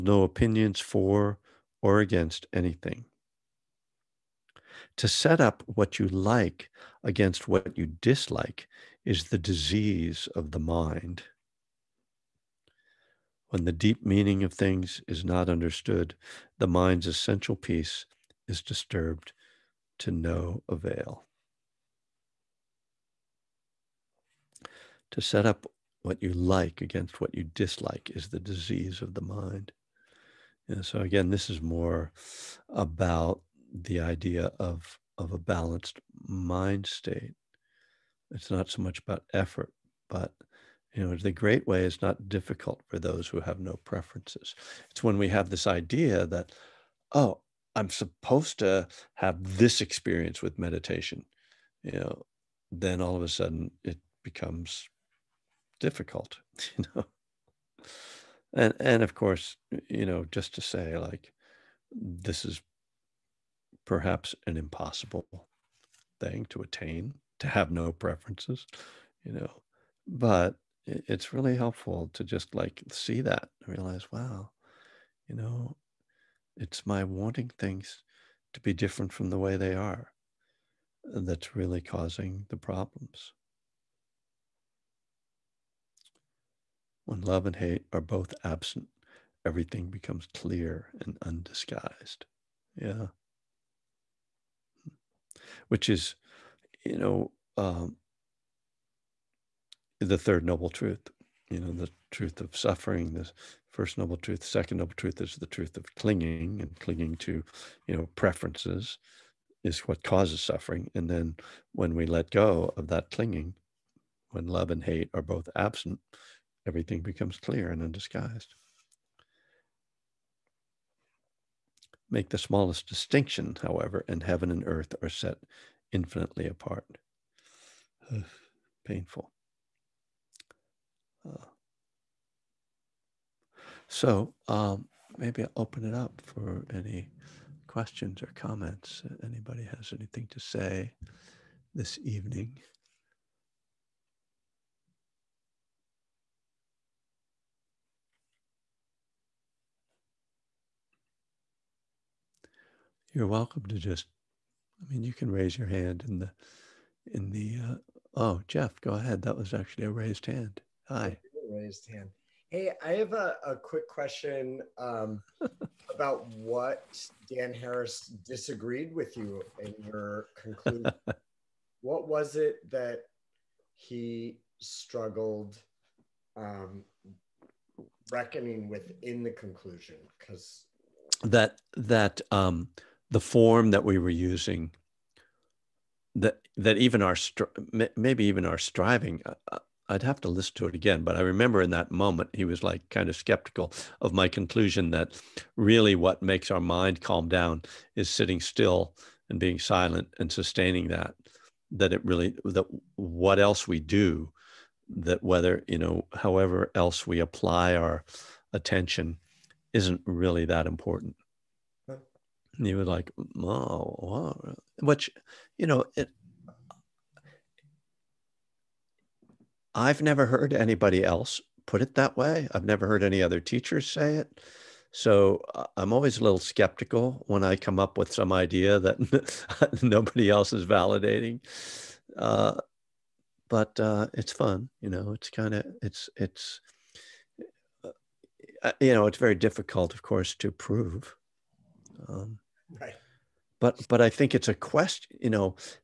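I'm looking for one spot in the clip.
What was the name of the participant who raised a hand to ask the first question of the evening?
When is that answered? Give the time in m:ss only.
2:38.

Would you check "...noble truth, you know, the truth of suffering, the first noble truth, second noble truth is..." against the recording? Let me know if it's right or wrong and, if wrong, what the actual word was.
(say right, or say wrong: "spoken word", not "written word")
right.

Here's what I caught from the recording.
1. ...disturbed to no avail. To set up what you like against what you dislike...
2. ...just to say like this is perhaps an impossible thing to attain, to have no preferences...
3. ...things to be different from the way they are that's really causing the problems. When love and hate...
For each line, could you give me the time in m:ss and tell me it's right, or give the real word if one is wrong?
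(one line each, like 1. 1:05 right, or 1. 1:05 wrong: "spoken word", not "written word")
1. 0:18 right
2. 1:00 right
3. 1:17 right.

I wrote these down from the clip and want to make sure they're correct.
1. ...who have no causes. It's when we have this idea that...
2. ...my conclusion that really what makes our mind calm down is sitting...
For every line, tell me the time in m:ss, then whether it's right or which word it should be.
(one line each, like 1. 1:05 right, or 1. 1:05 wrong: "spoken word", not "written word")
1. 0:43 wrong: "preferences", not "causes"
2. 3:14 right.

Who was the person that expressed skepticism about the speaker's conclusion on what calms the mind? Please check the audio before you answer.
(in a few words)
Dan Harris.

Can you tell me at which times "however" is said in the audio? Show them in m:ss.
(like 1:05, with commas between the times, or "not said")
2:03, 3:26.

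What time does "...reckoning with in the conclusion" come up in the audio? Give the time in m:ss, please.
2:58.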